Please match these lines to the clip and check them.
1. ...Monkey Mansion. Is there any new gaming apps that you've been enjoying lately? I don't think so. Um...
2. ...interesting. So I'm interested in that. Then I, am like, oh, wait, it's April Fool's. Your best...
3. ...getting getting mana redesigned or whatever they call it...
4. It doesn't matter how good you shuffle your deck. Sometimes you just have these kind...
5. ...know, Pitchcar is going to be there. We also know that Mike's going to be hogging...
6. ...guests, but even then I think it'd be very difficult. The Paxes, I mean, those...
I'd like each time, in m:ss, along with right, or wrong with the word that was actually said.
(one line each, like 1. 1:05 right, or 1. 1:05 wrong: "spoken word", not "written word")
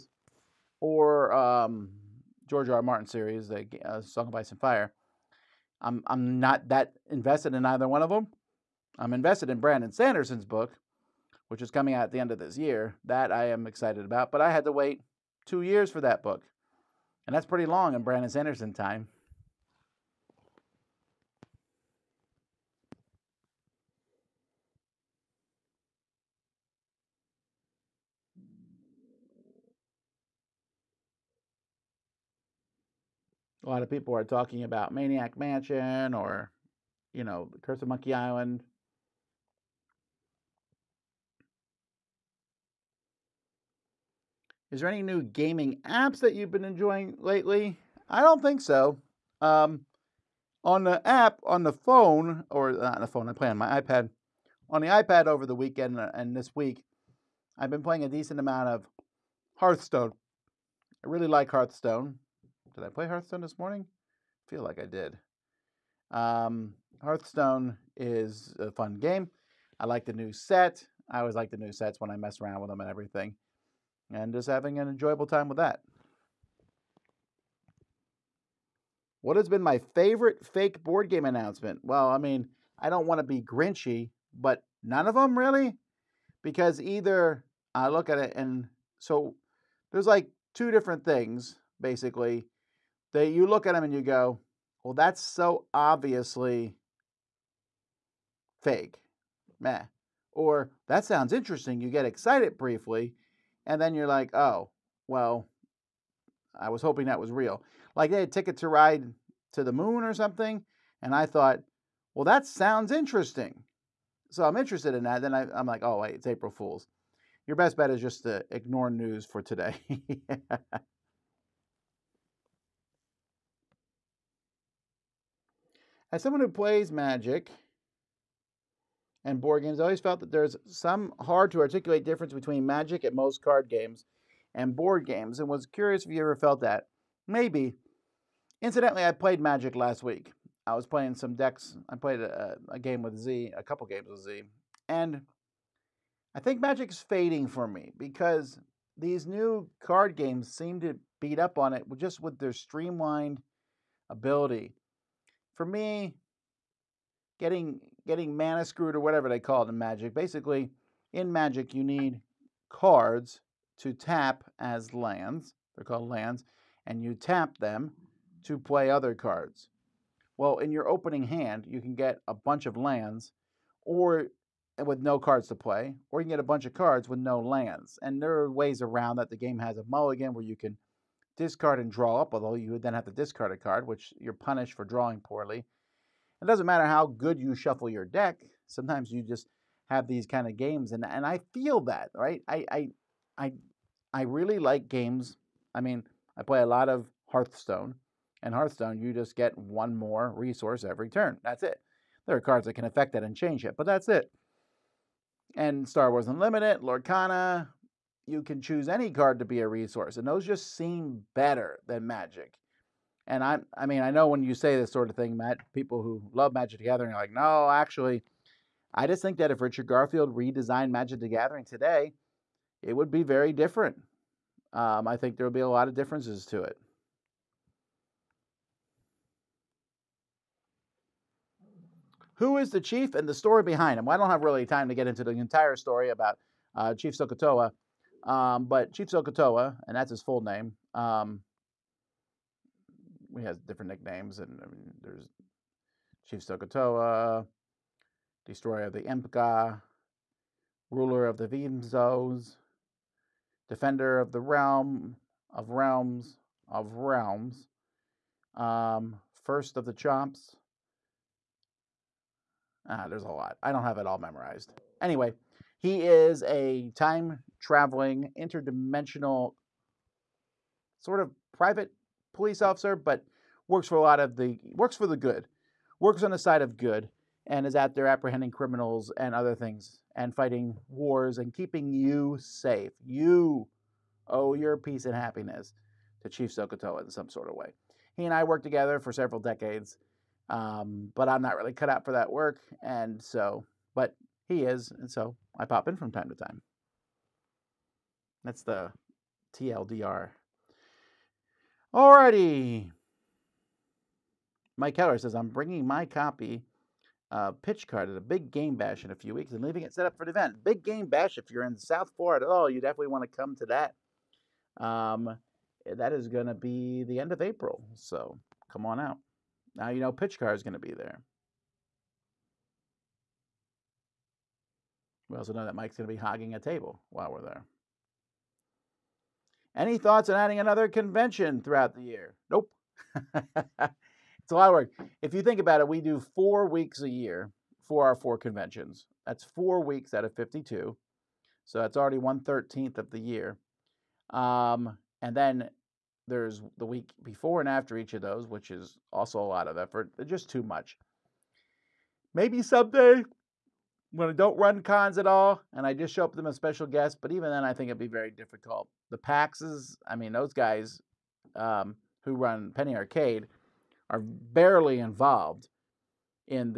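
1. 0:37 wrong: "Island", not "Mansion"
2. 1:52 right
3. 2:37 wrong: "screwed", not "redesigned"
4. 3:06 right
5. 5:19 right
6. 5:56 right.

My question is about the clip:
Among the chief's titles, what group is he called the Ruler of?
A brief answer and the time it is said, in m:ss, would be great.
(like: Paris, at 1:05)
the Vimzos, at 4:10.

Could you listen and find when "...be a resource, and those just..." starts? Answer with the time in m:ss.
3:29.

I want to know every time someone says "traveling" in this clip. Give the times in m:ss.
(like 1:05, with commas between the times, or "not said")
4:27.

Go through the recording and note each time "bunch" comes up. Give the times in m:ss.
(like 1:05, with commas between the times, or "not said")
2:52, 2:56.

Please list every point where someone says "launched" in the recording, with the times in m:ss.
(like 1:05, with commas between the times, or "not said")
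not said.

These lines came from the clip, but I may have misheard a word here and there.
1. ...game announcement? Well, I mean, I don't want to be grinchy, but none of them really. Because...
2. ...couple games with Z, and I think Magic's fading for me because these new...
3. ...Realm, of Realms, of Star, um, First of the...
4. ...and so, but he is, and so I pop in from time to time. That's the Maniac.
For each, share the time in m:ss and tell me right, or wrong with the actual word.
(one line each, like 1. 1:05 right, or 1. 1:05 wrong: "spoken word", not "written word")
1. 1:21 right
2. 2:23 right
3. 4:14 wrong: "Realms", not "Star"
4. 4:52 wrong: "TLDR", not "Maniac".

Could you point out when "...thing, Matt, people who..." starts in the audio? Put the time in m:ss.
3:35.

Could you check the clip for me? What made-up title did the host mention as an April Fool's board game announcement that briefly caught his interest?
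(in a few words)
Ticket to Ride to the Moon.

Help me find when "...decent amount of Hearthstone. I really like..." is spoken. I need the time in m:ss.
0:58.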